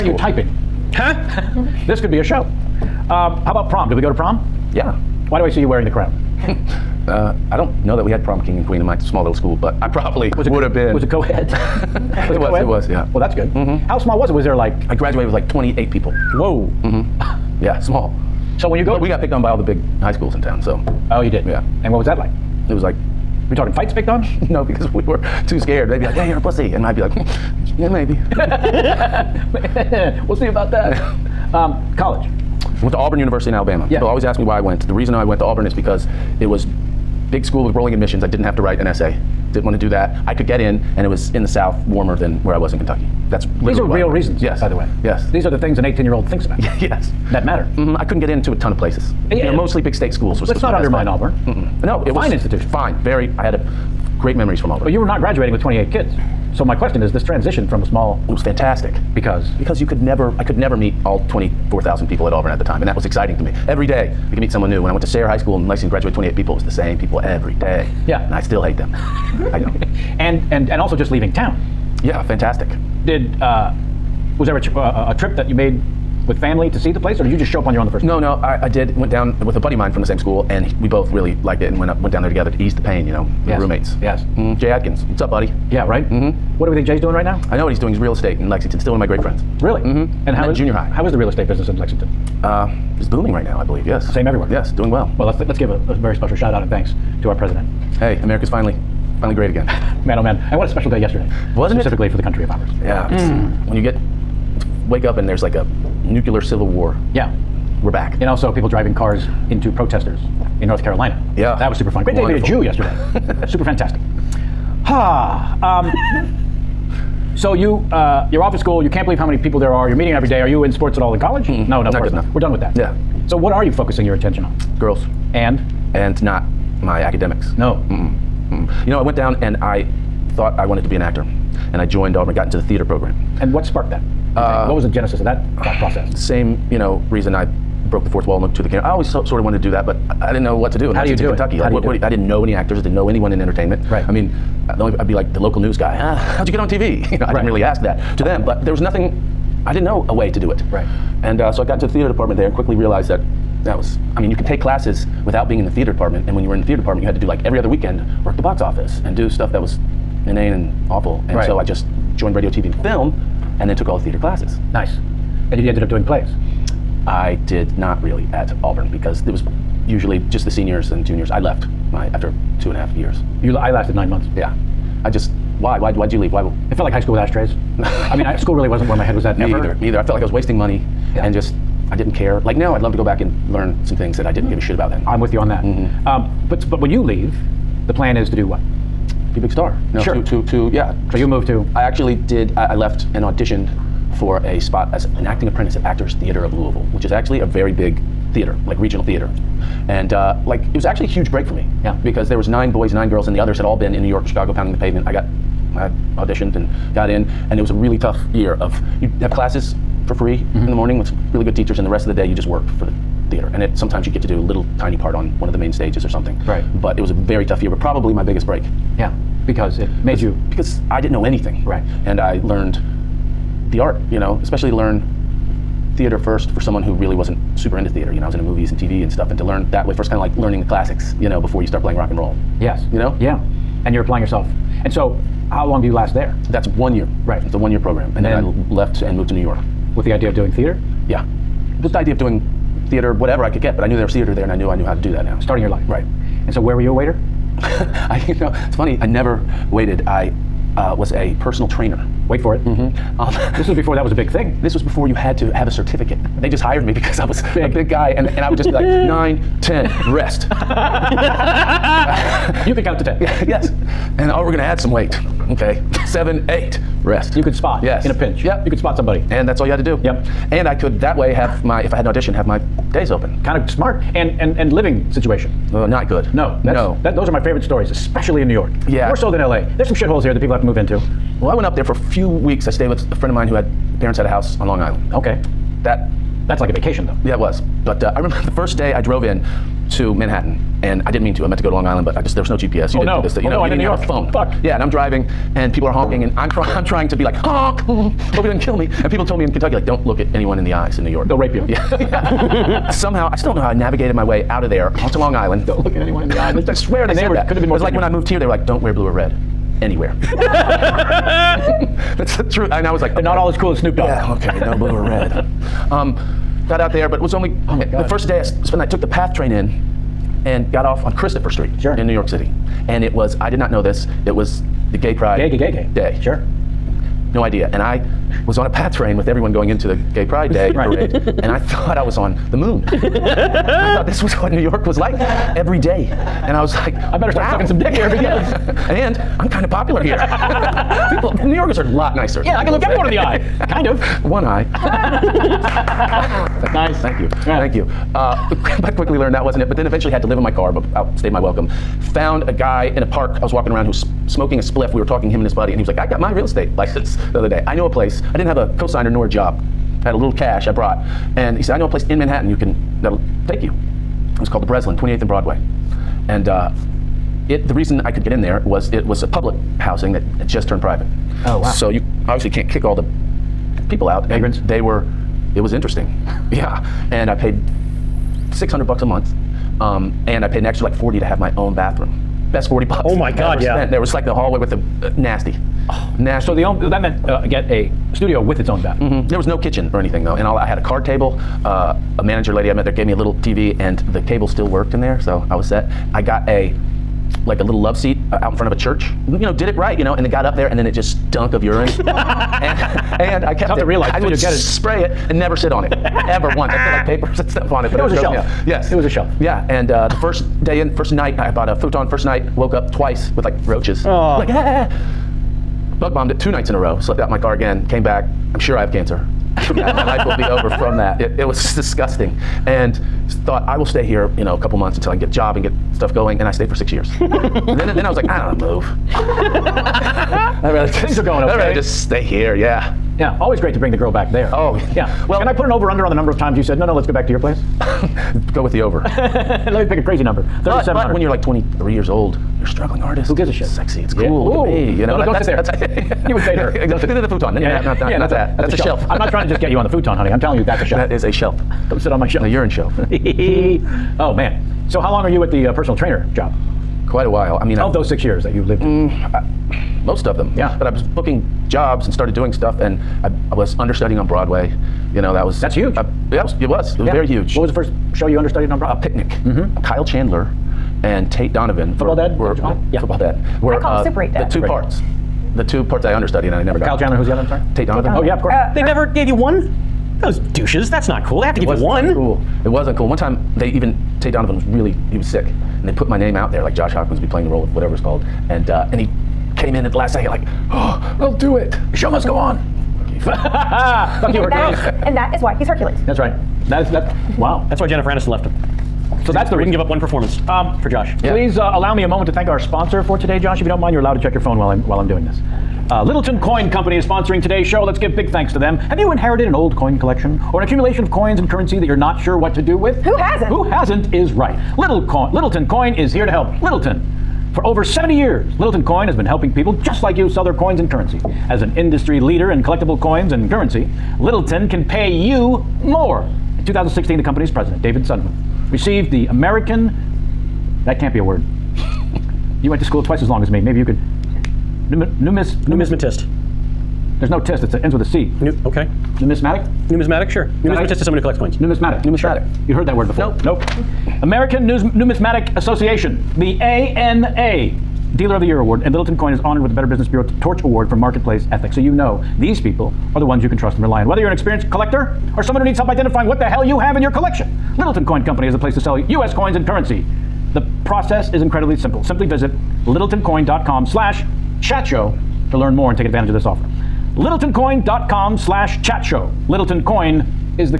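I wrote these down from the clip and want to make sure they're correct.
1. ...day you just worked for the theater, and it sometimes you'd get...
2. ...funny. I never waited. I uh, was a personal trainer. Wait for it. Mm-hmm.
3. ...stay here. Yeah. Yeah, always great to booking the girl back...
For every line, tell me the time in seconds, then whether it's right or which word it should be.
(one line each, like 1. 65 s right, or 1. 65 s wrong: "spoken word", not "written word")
1. 212 s right
2. 248 s right
3. 432 s wrong: "bring", not "booking".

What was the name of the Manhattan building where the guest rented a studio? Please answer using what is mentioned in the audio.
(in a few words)
the Breslin.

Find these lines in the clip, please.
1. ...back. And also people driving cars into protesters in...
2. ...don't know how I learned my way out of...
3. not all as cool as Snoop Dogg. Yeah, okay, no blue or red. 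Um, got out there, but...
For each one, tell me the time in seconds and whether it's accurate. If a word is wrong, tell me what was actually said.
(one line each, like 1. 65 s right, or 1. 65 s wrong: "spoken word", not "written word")
1. 107 s right
2. 303 s wrong: "navigated", not "learned"
3. 313 s right.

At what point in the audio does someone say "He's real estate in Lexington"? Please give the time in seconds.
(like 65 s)
87 s.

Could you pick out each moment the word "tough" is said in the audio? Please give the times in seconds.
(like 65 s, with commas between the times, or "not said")
207 s, 217 s, 403 s.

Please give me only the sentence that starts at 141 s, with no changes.
do what, do I didn't know any actors.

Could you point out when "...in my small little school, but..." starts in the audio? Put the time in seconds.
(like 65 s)
8 s.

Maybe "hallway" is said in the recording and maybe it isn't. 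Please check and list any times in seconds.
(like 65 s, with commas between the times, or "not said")
384 s.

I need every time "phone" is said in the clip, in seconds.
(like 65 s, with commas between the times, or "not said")
294 s, 504 s.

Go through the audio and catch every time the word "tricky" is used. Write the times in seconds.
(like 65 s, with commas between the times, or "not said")
not said.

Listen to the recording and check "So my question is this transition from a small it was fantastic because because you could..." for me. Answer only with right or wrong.
right.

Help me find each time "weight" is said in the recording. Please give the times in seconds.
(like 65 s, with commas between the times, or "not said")
264 s.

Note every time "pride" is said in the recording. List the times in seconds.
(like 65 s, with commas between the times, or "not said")
325 s, 330 s.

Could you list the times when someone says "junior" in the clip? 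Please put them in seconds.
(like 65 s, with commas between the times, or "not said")
90 s, 171 s.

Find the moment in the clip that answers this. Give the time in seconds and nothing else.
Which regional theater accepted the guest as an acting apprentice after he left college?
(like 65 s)
195 s.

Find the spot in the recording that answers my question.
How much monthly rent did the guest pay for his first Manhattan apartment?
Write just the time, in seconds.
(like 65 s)
378 s.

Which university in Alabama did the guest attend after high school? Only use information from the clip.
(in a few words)
Auburn University.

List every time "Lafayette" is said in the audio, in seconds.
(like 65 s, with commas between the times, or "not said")
not said.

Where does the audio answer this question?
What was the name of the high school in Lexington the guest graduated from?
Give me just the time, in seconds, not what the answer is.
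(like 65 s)
65 s.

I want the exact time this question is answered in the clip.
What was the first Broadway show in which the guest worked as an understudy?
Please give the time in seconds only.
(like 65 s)
468 s.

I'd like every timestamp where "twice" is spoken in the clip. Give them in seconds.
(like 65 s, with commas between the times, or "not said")
412 s, 533 s.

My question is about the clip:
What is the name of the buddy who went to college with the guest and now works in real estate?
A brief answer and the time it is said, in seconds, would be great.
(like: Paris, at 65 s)
Jay Atkins, at 84 s.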